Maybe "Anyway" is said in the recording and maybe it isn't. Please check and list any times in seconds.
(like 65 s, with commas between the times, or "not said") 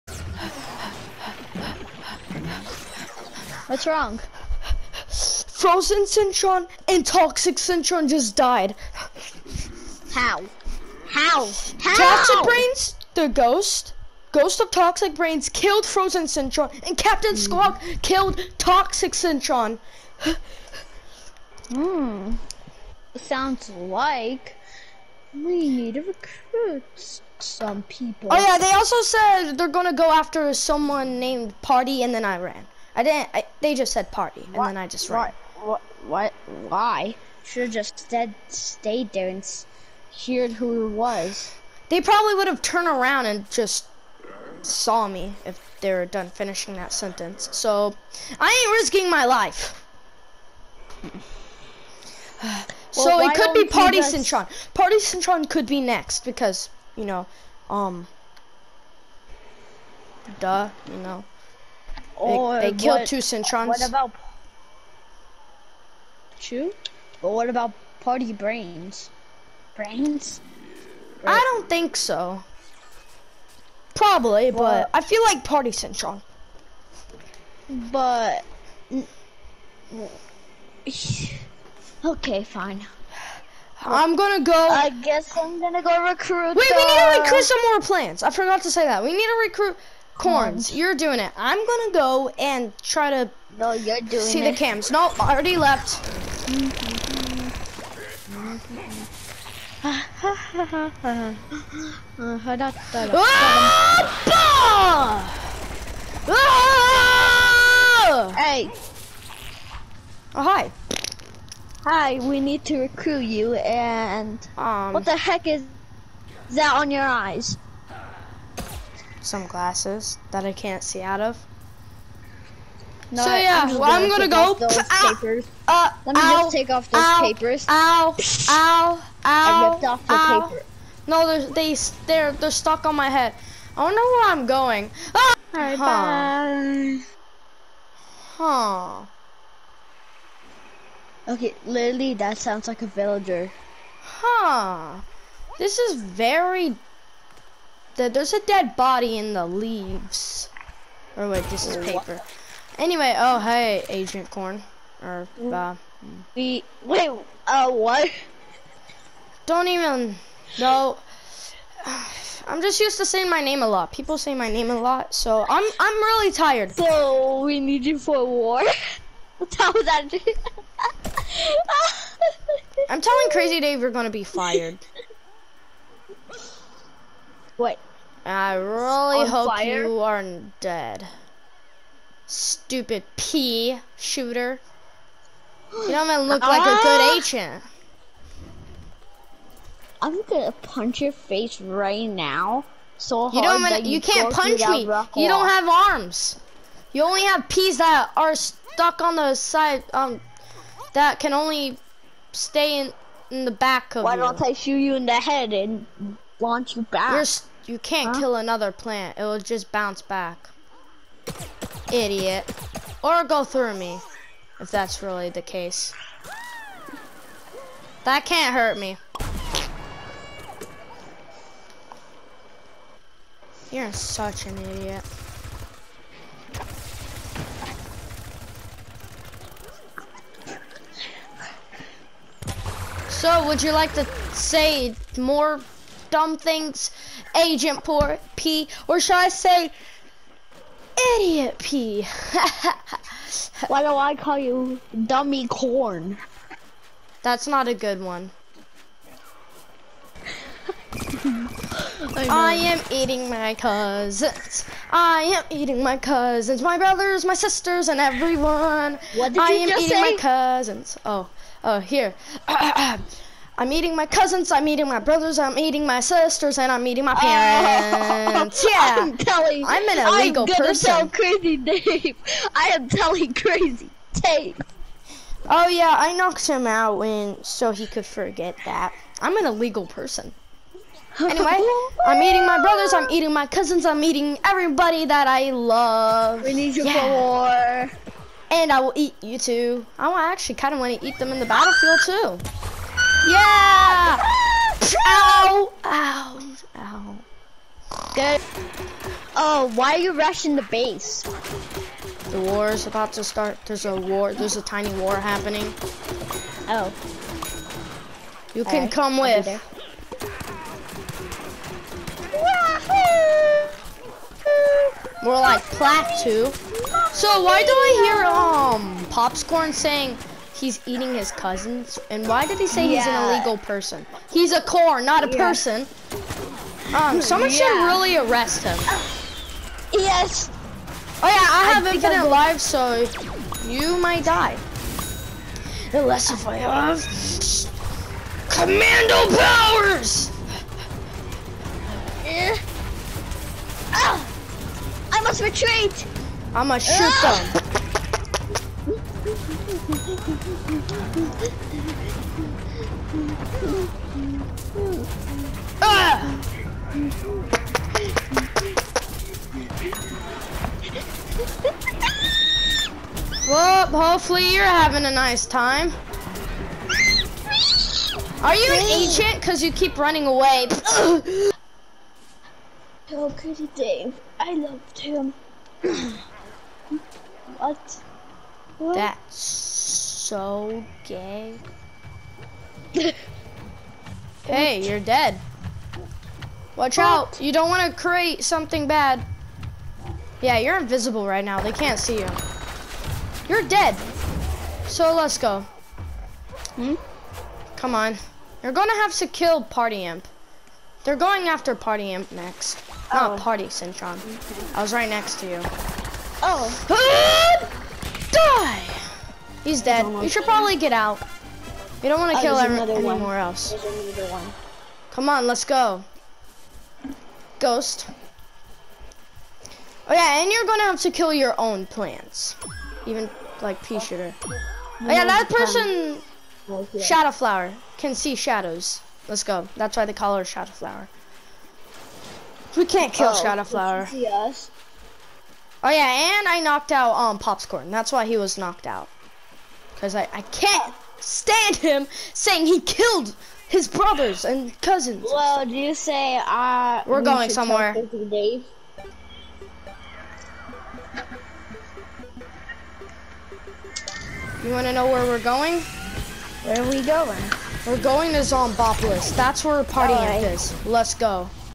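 152 s, 281 s.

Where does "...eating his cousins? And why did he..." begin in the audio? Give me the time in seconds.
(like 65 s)
320 s.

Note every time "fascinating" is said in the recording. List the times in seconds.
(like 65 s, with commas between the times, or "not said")
not said.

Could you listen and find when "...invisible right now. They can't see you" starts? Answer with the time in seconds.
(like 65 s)
390 s.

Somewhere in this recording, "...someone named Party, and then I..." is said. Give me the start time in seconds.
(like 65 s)
30 s.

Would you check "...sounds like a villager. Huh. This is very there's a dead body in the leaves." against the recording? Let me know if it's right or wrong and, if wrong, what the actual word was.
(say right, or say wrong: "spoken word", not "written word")
right.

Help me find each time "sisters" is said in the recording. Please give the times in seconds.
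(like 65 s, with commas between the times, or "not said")
257 s, 265 s.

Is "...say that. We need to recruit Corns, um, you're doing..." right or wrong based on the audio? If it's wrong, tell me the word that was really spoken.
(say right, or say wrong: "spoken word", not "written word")
right.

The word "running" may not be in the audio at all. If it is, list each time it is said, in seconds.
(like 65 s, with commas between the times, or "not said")
369 s.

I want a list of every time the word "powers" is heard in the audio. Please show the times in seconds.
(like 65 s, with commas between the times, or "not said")
339 s.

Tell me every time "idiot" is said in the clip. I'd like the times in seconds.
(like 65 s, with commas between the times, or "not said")
211 s, 224 s, 241 s.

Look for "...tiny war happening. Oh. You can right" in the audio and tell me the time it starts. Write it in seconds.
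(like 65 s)
304 s.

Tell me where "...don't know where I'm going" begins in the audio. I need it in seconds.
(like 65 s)
133 s.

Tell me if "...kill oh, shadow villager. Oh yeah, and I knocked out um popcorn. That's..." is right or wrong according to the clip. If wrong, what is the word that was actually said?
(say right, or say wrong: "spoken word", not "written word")
wrong: "flower", not "villager".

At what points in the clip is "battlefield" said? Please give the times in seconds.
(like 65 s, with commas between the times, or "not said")
291 s.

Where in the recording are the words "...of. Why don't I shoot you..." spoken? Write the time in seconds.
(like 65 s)
203 s.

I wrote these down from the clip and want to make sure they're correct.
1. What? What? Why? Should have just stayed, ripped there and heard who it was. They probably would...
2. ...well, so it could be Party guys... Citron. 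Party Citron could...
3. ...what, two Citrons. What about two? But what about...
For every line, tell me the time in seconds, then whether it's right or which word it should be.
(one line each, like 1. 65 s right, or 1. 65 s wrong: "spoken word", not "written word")
1. 35 s wrong: "stayed", not "ripped"
2. 52 s right
3. 62 s right.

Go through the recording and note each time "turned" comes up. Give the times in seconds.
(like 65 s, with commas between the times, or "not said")
42 s.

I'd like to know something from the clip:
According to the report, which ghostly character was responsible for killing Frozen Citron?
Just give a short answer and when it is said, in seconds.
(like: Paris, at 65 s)
Ghost of Toxic Brains, at 14 s.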